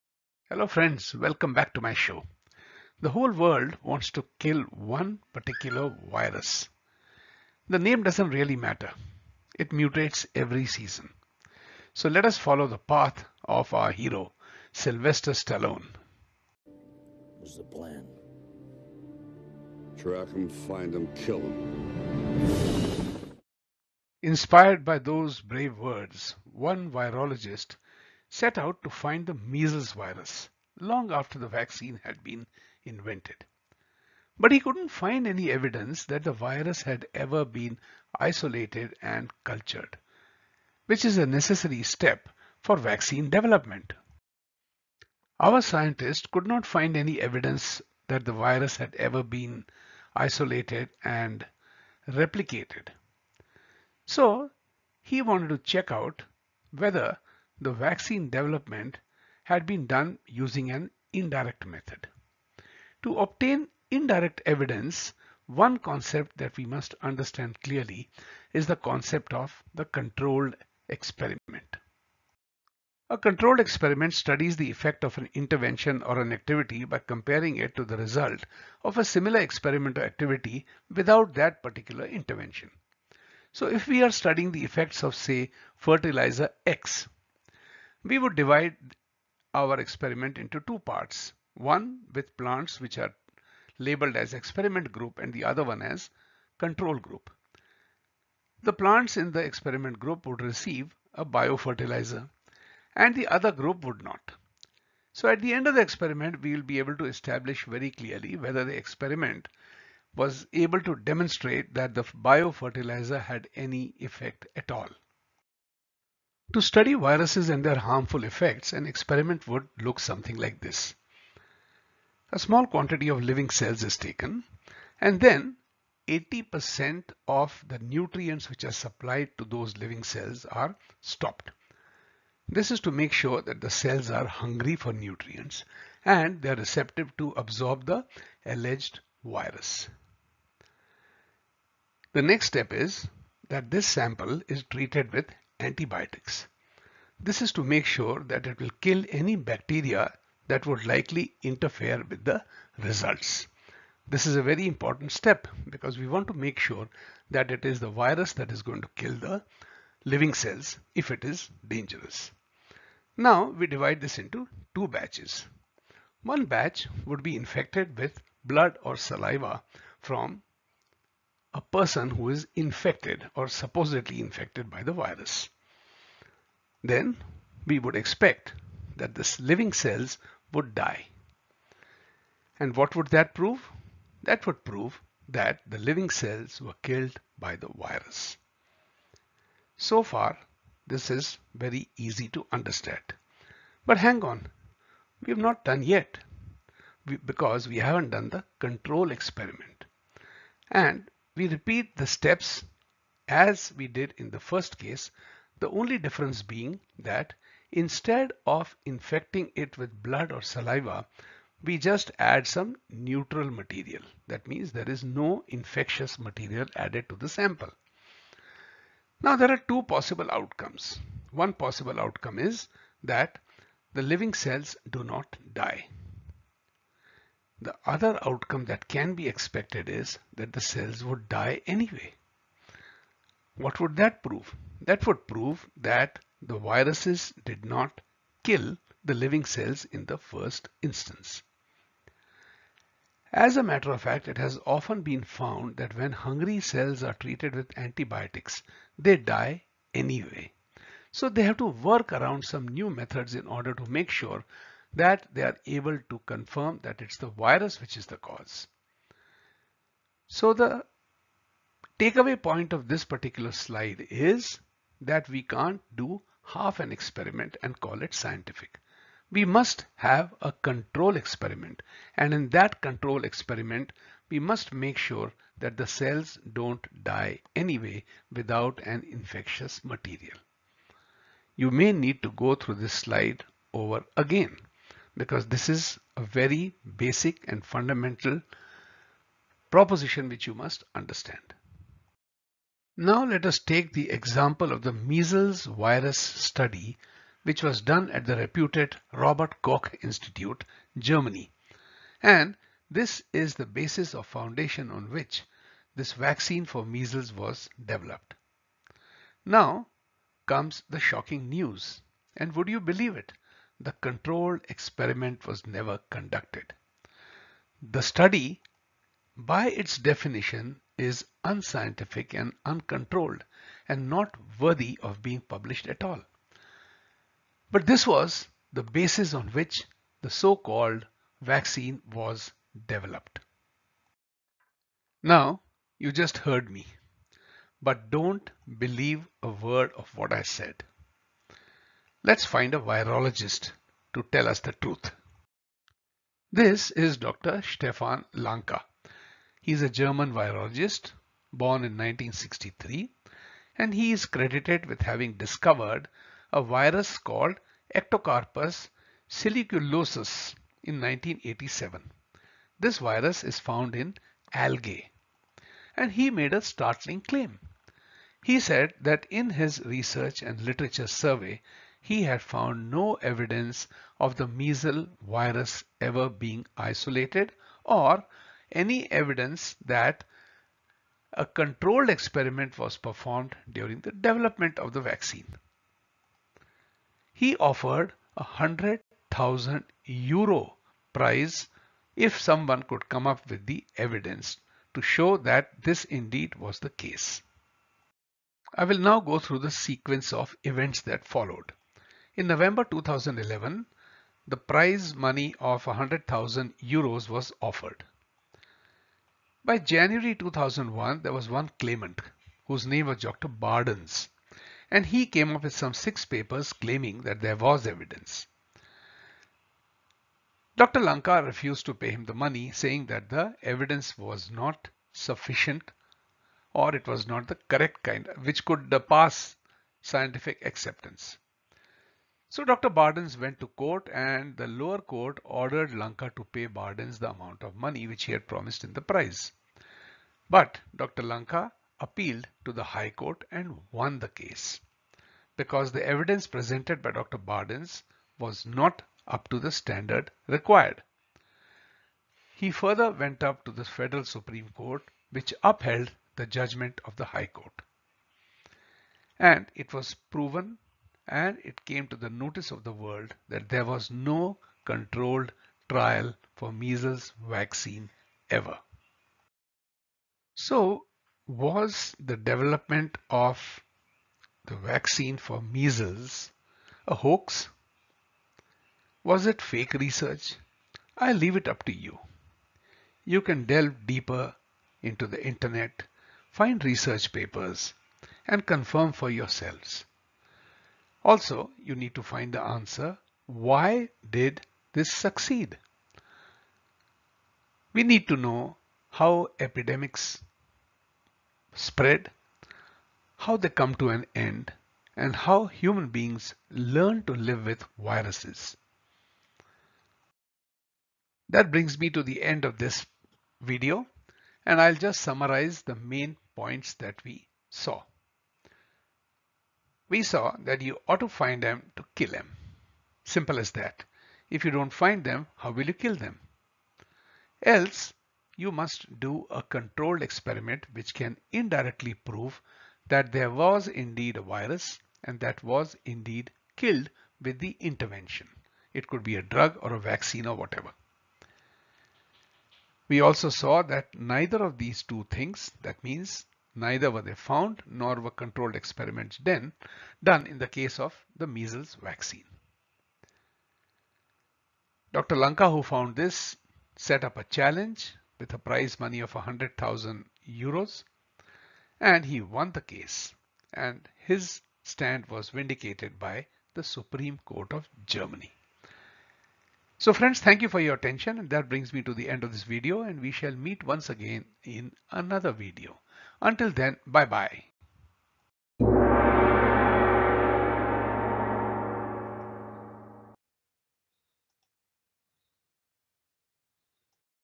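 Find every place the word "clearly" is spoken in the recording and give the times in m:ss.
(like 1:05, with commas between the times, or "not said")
1:07, 1:47.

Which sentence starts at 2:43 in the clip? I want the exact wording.
Now we divide this into two batches.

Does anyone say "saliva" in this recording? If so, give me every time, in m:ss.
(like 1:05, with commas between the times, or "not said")
2:48, 3:30.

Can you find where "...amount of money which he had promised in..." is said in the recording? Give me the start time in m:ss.
7:17.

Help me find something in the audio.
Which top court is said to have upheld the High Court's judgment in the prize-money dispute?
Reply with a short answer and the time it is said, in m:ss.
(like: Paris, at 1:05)
Federal Supreme Court, at 7:33.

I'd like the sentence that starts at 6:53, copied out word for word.
Bardens, and he came up with some six papers claiming that there was evidence.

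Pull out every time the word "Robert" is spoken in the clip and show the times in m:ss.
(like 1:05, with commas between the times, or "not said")
4:59.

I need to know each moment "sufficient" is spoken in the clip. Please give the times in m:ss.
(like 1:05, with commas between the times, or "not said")
7:05.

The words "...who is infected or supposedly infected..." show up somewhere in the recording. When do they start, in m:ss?
2:52.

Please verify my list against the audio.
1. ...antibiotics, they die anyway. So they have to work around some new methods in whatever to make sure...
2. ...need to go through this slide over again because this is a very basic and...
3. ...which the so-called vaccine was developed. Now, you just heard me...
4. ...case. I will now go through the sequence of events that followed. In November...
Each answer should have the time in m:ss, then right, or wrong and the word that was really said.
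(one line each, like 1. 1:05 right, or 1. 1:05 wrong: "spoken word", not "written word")
1. 4:07 wrong: "order", not "whatever"
2. 4:41 right
3. 5:29 right
4. 6:36 right.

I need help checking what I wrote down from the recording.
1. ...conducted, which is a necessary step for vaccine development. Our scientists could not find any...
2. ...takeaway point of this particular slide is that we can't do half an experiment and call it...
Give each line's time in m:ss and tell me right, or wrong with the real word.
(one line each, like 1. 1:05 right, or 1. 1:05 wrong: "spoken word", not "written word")
1. 0:39 wrong: "cultured", not "conducted"
2. 4:21 right.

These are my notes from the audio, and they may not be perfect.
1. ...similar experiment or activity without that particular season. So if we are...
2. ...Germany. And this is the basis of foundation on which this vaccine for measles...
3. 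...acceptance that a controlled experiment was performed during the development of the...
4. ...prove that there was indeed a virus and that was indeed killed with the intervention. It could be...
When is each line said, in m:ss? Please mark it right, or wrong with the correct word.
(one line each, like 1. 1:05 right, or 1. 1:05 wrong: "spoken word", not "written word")
1. 1:19 wrong: "intervention", not "season"
2. 5:00 right
3. 6:19 wrong: "evidence", not "acceptance"
4. 8:52 right.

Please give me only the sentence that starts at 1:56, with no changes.
To study viruses and their harmful effects, an experiment would look something like this.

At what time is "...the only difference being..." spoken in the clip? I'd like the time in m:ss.
3:25.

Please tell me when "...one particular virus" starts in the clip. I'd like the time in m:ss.
0:04.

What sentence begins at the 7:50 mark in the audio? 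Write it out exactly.
So was the development of the vaccine for measles a hoax?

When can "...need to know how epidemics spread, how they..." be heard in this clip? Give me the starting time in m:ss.
8:18.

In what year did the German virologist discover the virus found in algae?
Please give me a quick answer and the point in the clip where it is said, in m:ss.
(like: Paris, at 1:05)
1987, at 6:01.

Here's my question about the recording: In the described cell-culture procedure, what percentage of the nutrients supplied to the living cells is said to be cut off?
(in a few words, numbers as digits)
80%.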